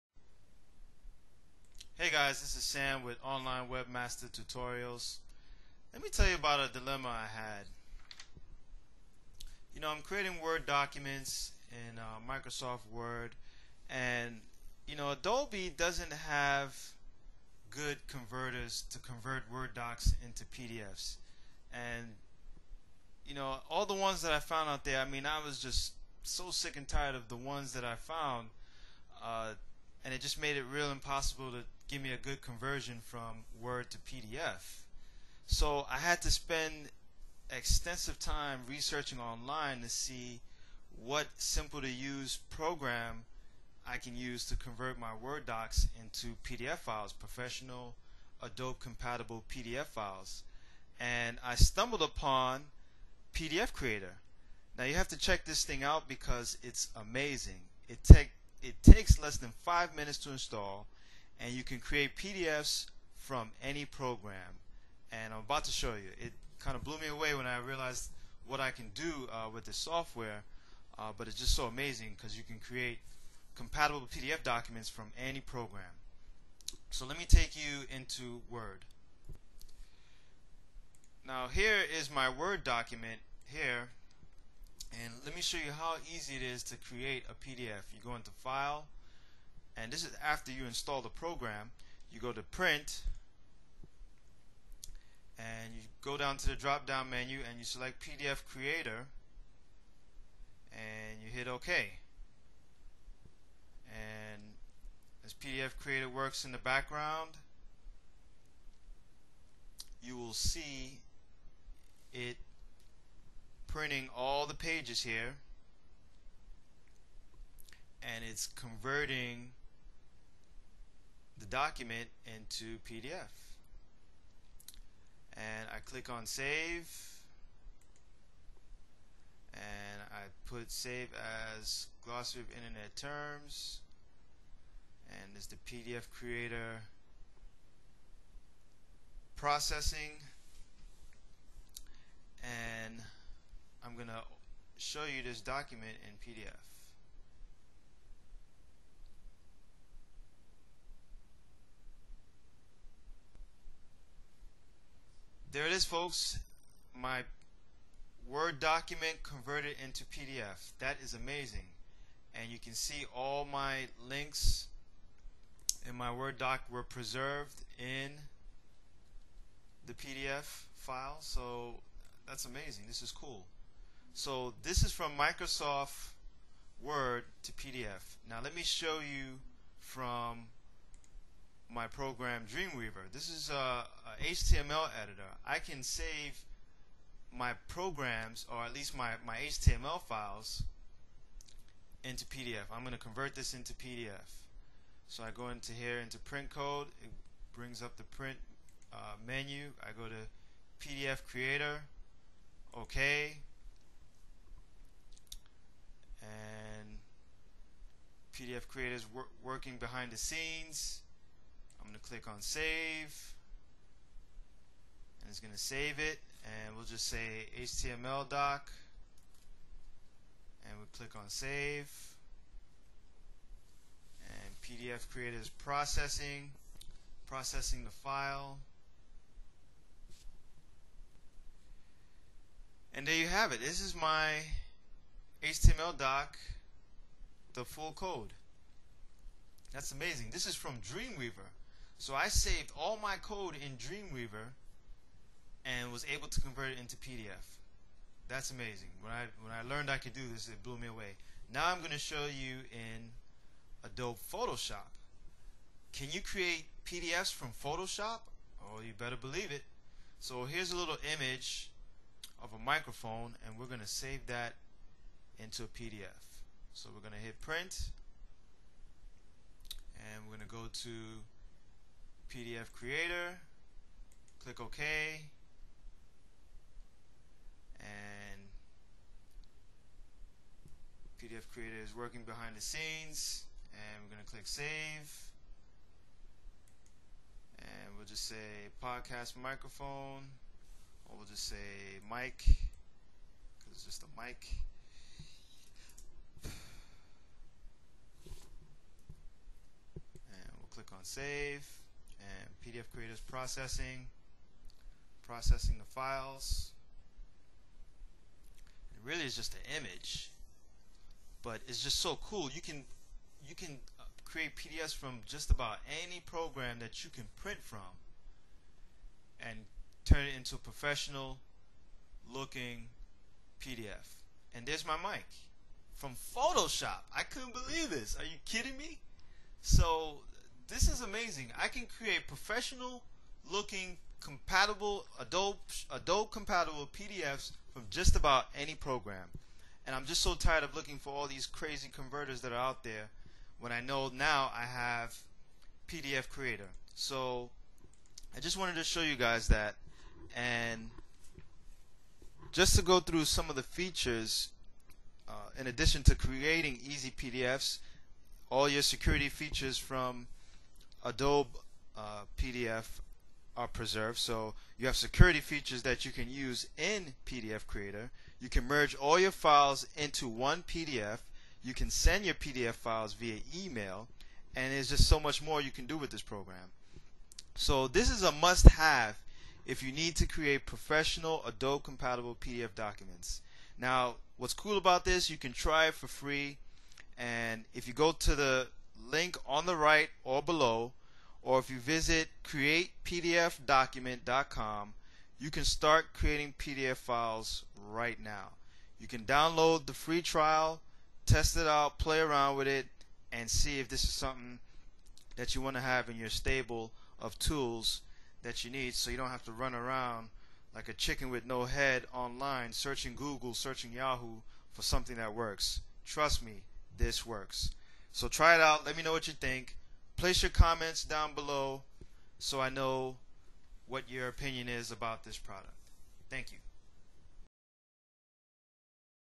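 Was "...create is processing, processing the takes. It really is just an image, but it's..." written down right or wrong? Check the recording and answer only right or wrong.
wrong.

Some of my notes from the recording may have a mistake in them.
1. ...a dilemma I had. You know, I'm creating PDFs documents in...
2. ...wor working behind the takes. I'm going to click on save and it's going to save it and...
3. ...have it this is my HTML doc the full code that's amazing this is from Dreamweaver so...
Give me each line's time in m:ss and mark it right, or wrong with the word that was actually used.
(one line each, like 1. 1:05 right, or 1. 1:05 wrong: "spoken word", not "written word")
1. 0:06 wrong: "Word", not "PDFs"
2. 3:29 wrong: "scenes", not "takes"
3. 3:53 right.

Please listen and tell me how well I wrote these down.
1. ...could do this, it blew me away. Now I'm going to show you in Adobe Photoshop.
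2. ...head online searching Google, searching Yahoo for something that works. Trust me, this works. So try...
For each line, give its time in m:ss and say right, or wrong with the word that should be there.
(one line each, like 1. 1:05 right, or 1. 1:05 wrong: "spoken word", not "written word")
1. 4:09 right
2. 6:51 right.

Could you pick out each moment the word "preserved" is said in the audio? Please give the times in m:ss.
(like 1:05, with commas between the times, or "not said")
2:46, 6:03.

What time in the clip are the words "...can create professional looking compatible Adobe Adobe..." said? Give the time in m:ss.
5:31.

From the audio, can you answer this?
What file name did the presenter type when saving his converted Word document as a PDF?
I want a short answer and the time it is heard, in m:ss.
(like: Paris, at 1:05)
glossary of internet terms, at 2:12.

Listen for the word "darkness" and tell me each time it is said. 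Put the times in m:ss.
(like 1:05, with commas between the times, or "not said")
not said.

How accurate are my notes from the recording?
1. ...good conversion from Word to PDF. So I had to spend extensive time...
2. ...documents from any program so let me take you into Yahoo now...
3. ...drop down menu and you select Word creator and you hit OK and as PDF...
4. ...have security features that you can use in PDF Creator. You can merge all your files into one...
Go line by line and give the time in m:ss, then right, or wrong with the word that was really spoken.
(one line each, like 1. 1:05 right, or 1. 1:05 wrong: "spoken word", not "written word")
1. 0:32 right
2. 1:14 wrong: "Word", not "Yahoo"
3. 1:36 wrong: "PDF", not "Word"
4. 6:04 right.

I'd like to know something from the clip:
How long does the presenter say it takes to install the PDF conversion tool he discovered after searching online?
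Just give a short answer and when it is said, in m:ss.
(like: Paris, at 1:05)
less than 5 minutes, at 0:59.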